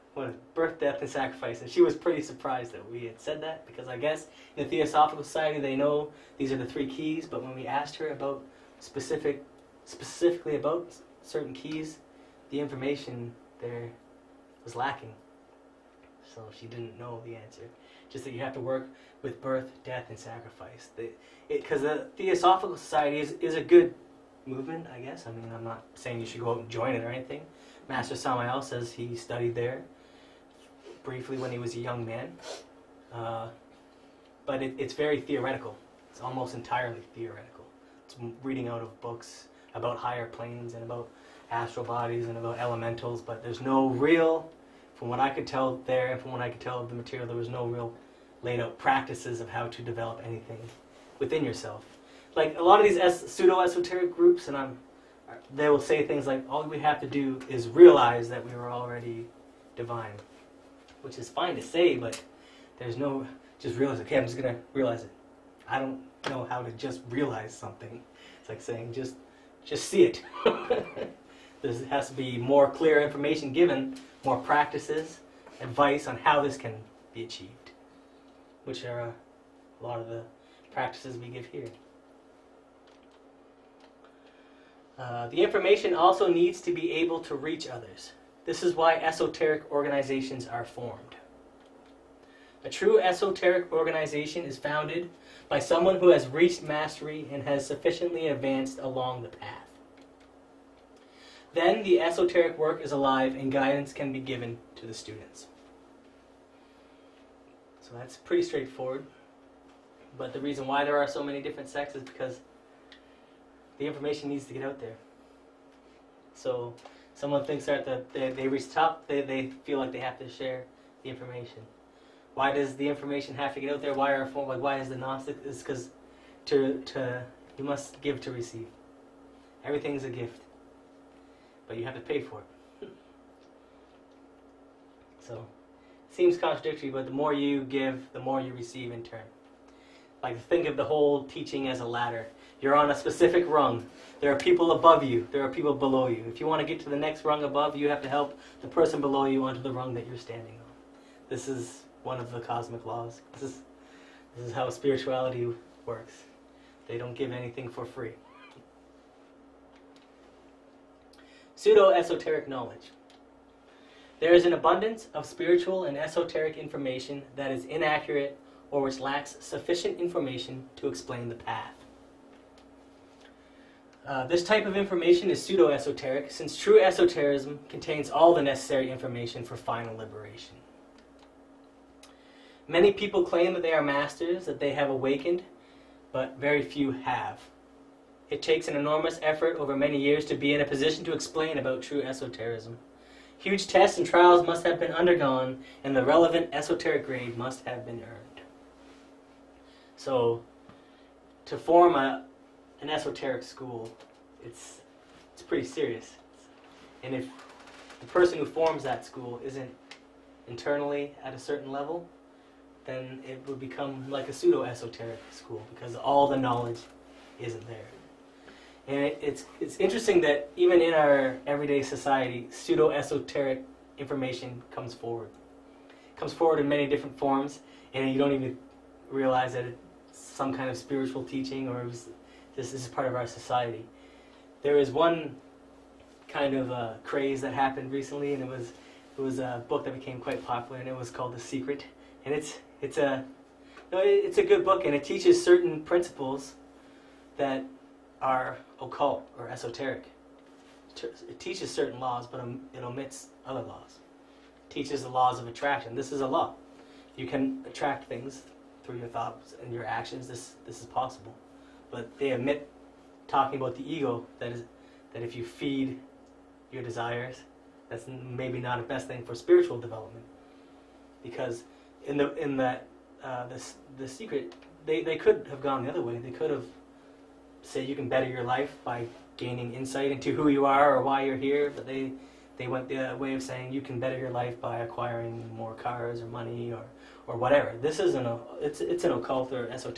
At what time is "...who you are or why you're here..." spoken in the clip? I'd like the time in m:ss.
4:40.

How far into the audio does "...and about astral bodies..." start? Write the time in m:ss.
0:40.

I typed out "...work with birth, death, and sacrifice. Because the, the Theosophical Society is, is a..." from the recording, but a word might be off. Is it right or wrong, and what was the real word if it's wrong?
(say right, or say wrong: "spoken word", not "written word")
right.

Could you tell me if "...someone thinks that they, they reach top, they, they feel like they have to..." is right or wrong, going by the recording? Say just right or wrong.
right.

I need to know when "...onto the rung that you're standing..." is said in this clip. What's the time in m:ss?
2:29.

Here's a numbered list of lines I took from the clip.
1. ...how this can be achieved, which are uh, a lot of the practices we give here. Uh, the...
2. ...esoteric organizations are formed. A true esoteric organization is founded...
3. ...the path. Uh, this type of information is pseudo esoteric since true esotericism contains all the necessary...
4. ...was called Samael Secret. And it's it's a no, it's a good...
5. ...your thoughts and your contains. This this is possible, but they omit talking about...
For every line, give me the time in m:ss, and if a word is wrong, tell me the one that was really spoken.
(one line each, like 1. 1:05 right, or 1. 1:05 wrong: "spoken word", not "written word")
1. 1:16 right
2. 1:28 right
3. 2:51 right
4. 4:00 wrong: "The", not "Samael"
5. 4:18 wrong: "actions", not "contains".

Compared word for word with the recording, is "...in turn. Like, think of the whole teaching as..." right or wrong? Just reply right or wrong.
right.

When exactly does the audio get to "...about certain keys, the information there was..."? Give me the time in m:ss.
0:10.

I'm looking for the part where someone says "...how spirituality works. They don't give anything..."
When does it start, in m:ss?
2:34.